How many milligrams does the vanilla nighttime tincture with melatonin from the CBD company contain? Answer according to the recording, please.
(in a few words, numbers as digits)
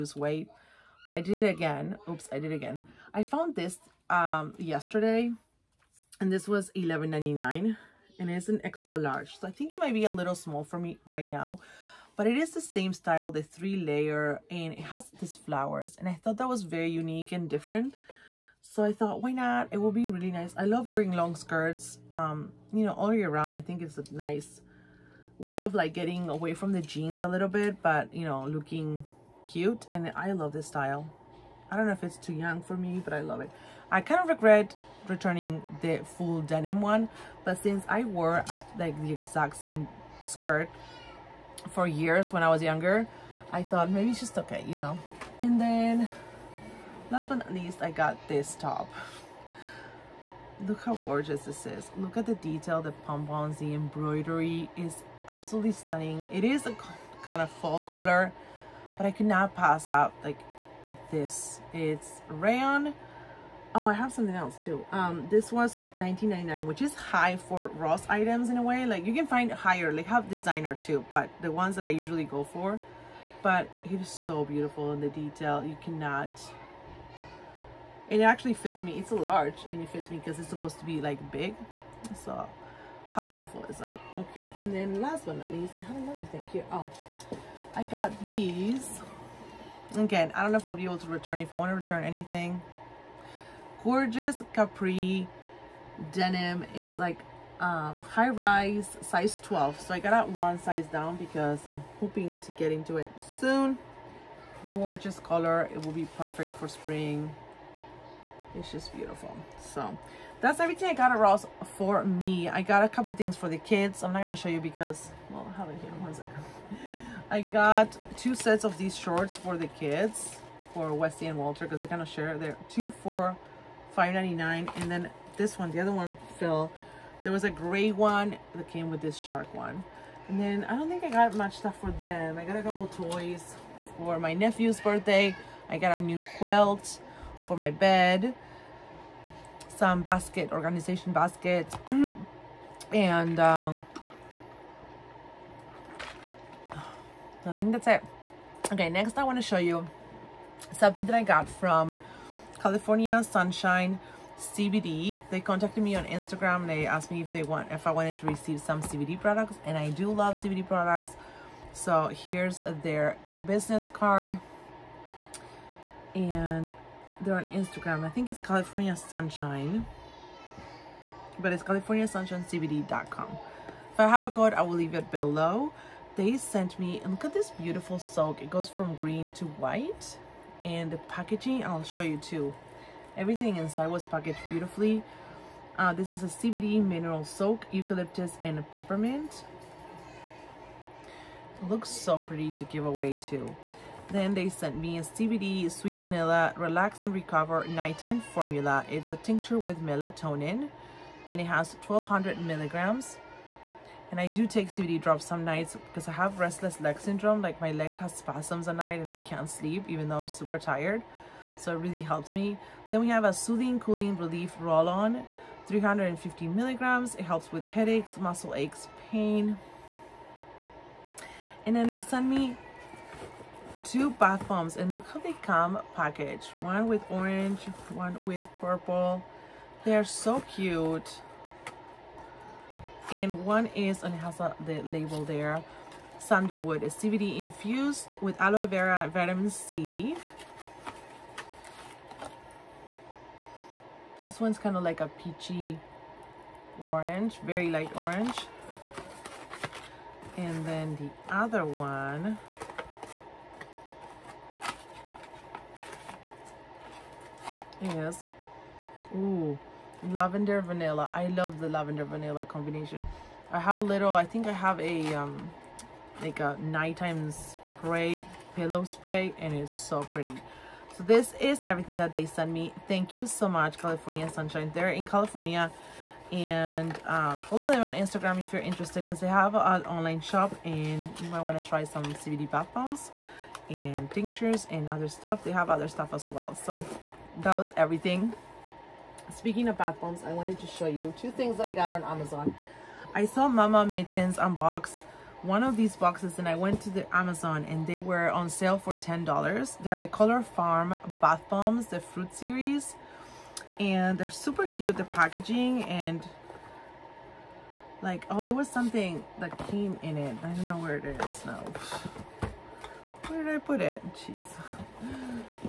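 1200.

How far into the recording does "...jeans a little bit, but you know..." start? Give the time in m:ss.
0:26.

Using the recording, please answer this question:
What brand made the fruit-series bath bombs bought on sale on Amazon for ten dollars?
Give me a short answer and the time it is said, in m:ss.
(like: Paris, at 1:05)
Color Farm, at 5:00.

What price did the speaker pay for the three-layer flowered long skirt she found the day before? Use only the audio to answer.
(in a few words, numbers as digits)
$11.99.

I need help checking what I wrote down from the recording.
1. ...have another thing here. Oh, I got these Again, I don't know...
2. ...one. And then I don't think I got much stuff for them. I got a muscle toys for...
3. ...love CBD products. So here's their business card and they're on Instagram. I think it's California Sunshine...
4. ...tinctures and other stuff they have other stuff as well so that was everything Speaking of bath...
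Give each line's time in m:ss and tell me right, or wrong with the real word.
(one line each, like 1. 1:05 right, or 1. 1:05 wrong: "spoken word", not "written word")
1. 1:25 right
2. 2:09 wrong: "couple", not "muscle"
3. 2:40 right
4. 4:44 right.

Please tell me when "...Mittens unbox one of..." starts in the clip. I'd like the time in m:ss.
4:53.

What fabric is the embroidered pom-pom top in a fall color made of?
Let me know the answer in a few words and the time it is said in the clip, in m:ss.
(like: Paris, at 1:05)
Rayon, at 1:02.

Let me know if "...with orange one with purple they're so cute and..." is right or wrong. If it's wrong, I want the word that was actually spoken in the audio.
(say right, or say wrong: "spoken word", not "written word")
right.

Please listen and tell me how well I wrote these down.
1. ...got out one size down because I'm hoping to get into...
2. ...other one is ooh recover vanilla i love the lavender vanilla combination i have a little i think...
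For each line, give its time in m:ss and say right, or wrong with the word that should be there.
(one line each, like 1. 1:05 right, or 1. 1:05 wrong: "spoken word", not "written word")
1. 1:39 right
2. 4:11 wrong: "lavender", not "recover".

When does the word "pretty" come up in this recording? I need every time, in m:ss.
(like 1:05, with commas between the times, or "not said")
3:12, 4:30.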